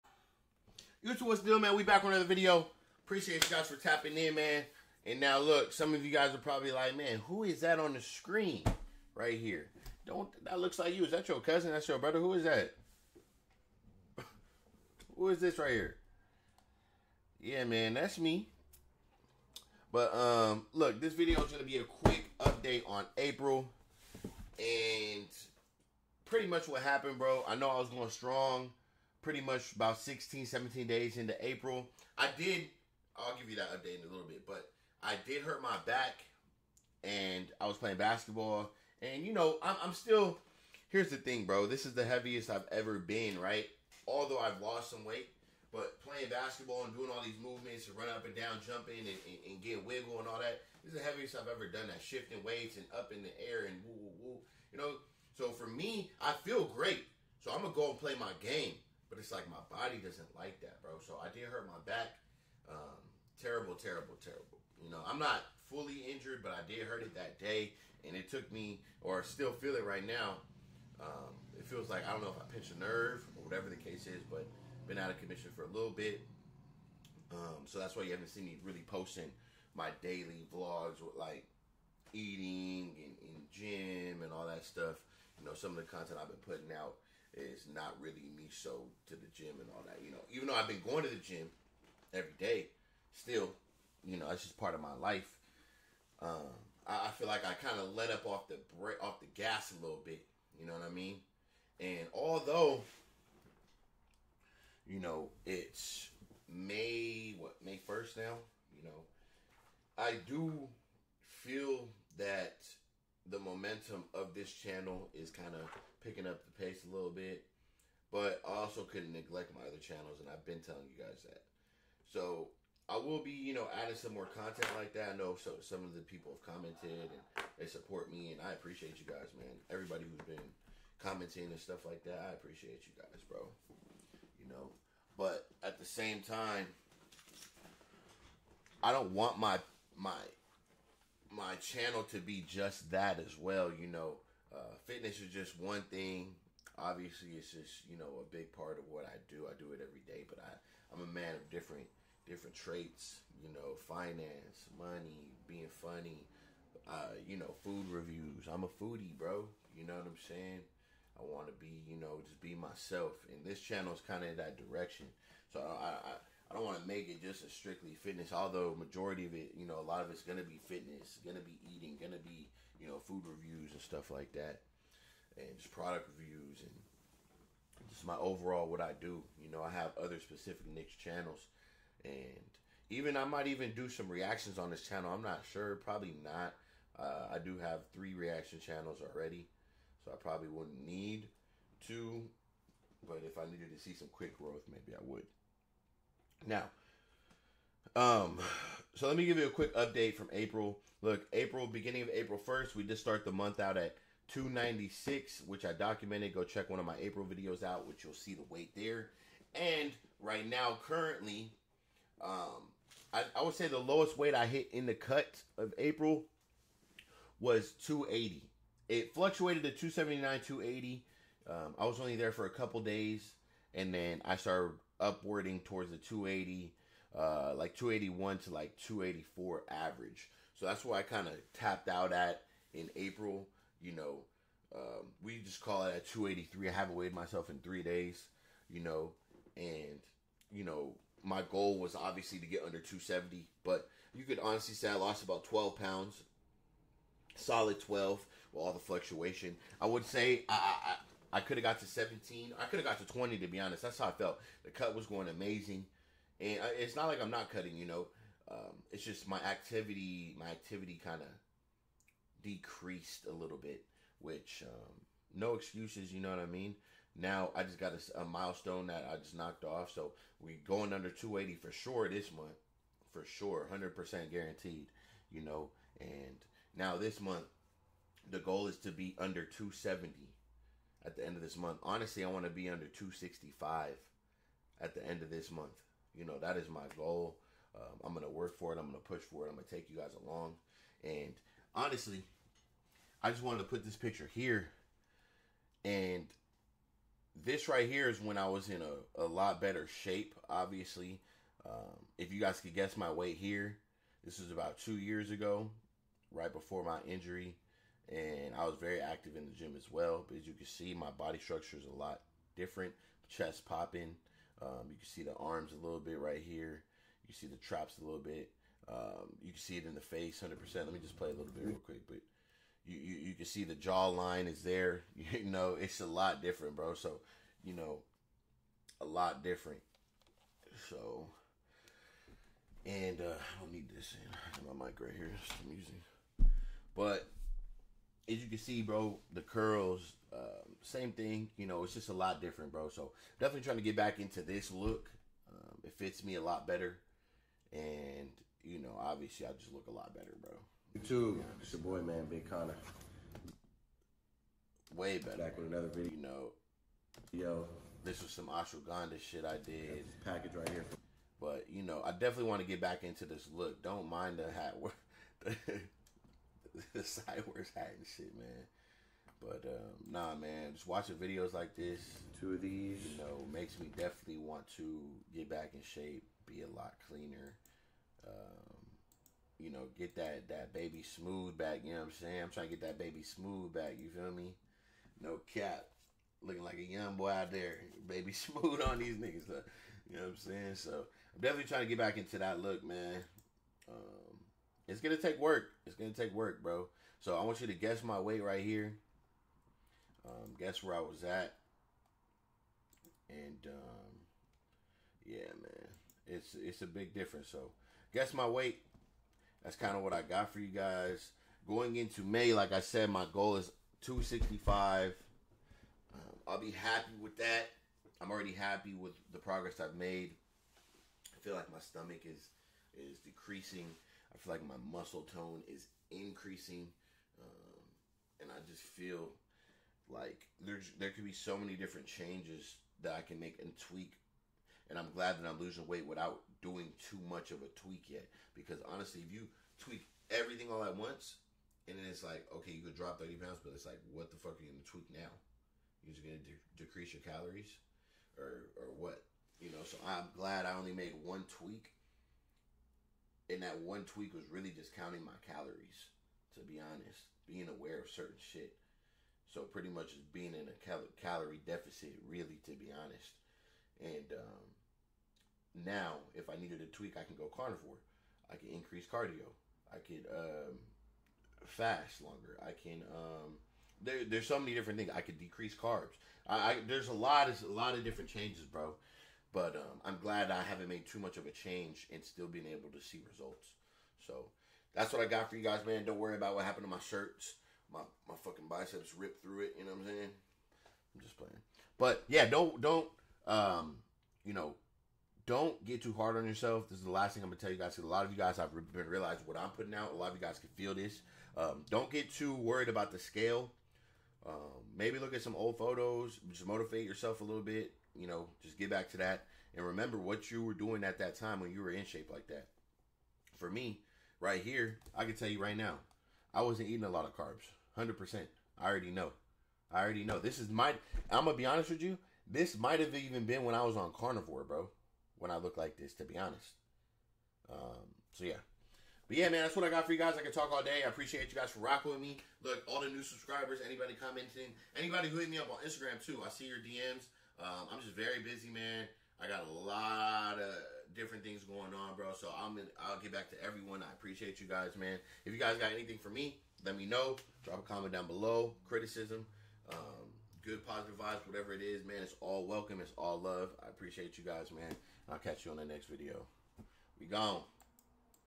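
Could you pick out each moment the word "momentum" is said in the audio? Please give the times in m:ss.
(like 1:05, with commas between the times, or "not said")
1:53.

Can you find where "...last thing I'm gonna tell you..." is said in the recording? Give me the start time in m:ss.
8:17.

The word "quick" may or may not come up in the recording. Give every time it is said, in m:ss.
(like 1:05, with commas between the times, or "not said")
0:21, 3:14, 3:19, 5:21.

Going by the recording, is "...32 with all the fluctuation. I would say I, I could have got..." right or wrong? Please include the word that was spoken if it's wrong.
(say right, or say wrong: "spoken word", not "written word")
wrong: "12", not "32".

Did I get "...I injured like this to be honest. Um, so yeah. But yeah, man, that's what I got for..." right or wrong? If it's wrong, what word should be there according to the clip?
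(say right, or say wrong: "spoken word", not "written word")
wrong: "looked", not "injured".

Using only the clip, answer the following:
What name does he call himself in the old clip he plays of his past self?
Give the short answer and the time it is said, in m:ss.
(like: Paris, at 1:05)
Big Kana, at 5:52.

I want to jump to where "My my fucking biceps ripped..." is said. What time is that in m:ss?
8:07.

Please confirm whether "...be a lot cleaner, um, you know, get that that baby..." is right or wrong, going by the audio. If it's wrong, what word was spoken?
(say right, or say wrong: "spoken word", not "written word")
right.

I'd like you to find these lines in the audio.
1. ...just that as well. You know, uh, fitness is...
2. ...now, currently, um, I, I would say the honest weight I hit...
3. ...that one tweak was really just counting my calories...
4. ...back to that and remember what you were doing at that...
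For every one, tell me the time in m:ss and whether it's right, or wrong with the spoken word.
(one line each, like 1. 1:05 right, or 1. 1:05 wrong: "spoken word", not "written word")
1. 2:22 right
2. 3:30 wrong: "lowest", not "honest"
3. 7:33 right
4. 8:28 right.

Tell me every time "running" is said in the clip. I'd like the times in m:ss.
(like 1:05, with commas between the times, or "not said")
0:47.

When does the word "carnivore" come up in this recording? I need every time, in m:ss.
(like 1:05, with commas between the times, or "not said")
7:47, 8:44.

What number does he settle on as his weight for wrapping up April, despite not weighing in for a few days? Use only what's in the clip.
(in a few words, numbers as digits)
283.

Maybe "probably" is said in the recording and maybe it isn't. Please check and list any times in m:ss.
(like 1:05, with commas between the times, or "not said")
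0:06, 3:05, 3:10.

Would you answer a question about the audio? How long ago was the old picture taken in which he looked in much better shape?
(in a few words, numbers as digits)
2 years.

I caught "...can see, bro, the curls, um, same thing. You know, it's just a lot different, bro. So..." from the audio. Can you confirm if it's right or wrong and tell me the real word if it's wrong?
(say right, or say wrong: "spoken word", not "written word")
right.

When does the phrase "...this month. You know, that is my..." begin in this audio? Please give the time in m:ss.
4:45.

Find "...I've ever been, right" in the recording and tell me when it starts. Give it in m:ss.
0:42.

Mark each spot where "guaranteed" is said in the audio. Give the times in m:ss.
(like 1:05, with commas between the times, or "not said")
4:34.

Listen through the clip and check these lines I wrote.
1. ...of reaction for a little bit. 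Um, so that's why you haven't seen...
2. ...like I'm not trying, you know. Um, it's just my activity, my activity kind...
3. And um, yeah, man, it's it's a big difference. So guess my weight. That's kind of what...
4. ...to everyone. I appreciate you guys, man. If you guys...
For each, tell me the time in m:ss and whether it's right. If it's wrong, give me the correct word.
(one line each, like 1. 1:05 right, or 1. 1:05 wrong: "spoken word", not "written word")
1. 1:15 wrong: "commission", not "reaction"
2. 4:17 wrong: "cutting", not "trying"
3. 6:43 right
4. 9:03 right.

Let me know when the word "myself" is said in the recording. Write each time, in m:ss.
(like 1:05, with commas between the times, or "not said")
2:42, 3:57.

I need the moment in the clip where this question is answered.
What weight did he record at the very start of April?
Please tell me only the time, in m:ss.
3:24.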